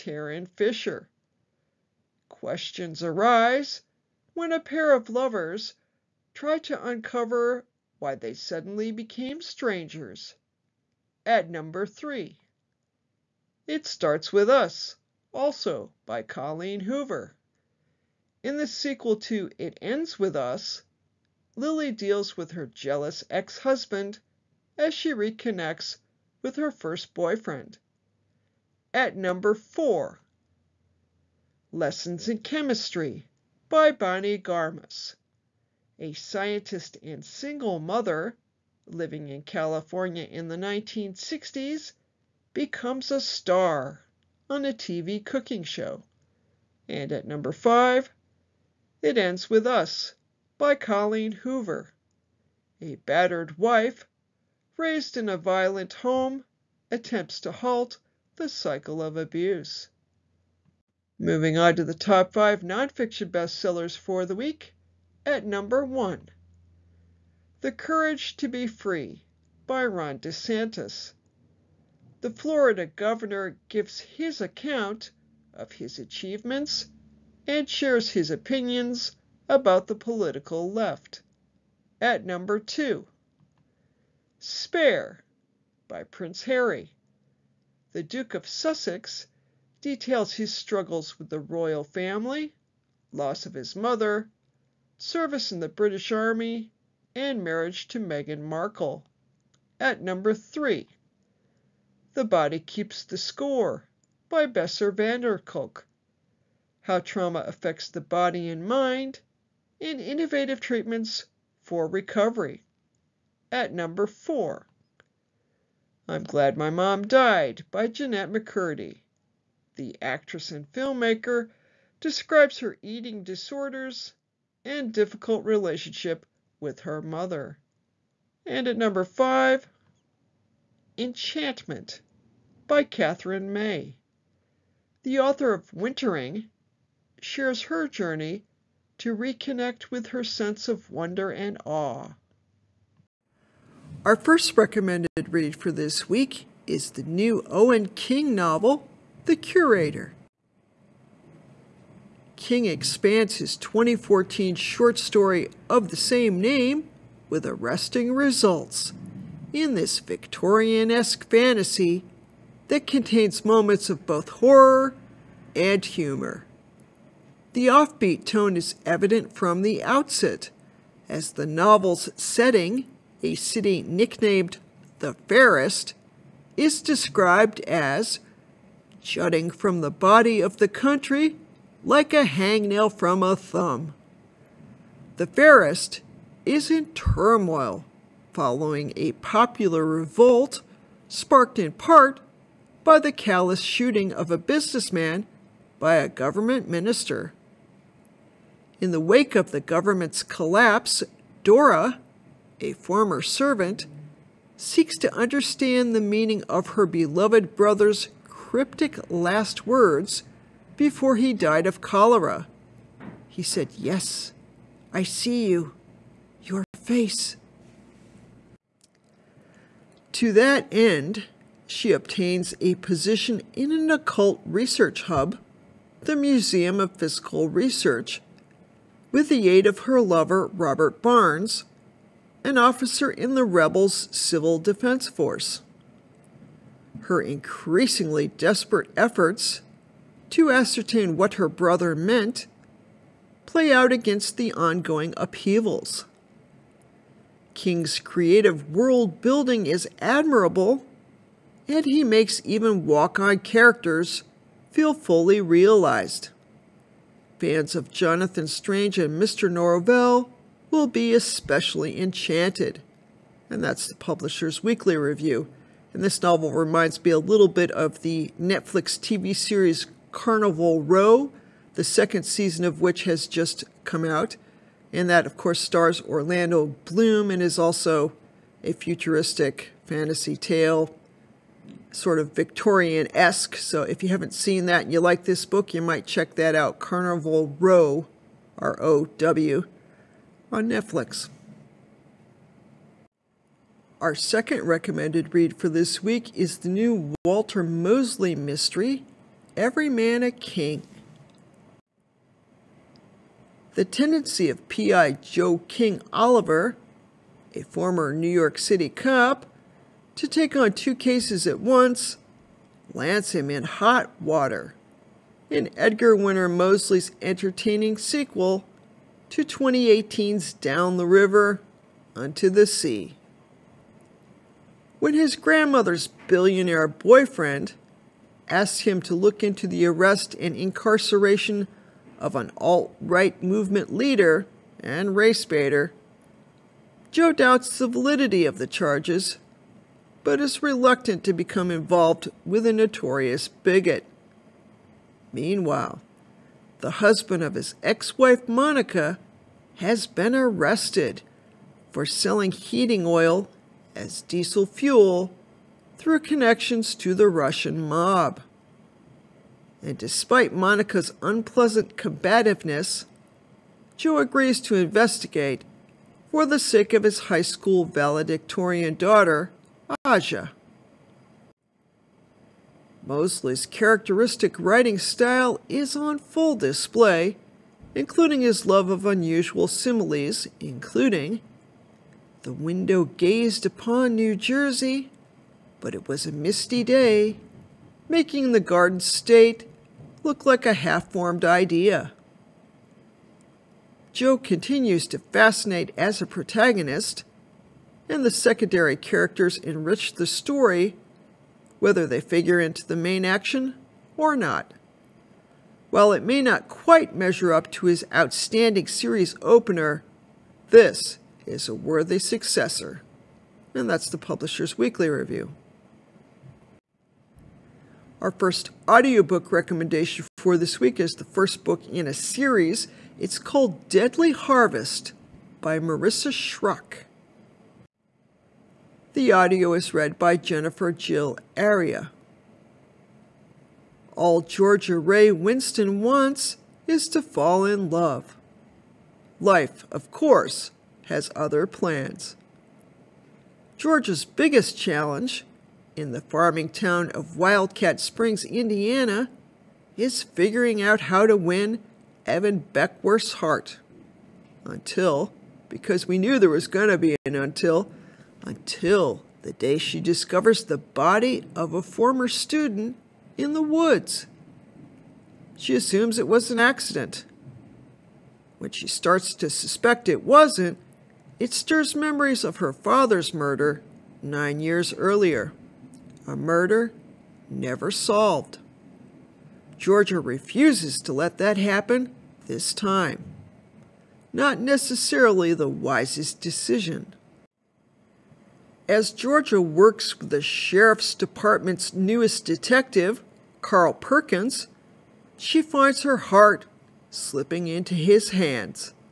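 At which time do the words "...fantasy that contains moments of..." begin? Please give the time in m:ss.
2:41.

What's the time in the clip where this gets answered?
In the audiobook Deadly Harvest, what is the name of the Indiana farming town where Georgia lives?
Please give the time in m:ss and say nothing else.
7:27.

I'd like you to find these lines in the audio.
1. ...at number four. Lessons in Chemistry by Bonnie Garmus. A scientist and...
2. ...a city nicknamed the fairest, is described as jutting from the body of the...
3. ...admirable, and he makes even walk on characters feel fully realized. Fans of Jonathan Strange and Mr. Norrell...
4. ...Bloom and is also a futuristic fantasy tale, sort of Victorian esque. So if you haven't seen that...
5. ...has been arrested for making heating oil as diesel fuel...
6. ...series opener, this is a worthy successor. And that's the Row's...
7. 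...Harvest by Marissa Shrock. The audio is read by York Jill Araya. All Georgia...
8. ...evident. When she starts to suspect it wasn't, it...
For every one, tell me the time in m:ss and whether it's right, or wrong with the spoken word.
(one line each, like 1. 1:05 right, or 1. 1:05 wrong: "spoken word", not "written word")
1. 0:28 right
2. 2:53 right
3. 4:09 right
4. 4:36 right
5. 5:49 wrong: "selling", not "making"
6. 6:48 wrong: "Publisher", not "Row"
7. 7:04 wrong: "Jennifer", not "York"
8. 7:46 wrong: "accident", not "evident".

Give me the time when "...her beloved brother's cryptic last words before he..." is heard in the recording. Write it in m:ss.
3:26.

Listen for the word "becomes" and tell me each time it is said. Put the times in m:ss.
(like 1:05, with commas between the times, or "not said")
0:42, 5:41.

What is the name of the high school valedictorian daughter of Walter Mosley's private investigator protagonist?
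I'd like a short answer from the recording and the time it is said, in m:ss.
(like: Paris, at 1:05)
Aja, at 6:10.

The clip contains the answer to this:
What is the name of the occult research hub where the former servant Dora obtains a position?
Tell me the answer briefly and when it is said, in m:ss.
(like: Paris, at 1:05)
Museum of Physical Research, at 3:46.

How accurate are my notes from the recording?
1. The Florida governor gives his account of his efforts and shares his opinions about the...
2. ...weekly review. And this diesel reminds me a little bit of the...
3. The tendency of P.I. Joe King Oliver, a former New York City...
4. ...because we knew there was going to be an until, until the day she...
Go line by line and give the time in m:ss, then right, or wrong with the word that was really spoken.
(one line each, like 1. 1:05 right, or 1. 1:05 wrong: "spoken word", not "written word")
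1. 1:12 wrong: "achievements", not "efforts"
2. 4:24 wrong: "novel", not "diesel"
3. 5:03 right
4. 7:35 right.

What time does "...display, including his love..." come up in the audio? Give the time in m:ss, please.
6:16.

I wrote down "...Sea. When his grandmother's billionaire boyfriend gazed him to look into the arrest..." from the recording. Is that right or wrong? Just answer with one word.
wrong.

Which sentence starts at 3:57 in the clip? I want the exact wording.
Her increasingly desperate efforts to ascertain what her brother meant play out against the ongoing upheavals.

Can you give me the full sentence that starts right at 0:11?
At number three, It Starts With Us, also by Colleen Hoover.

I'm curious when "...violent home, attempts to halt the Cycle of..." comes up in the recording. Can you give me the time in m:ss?
0:55.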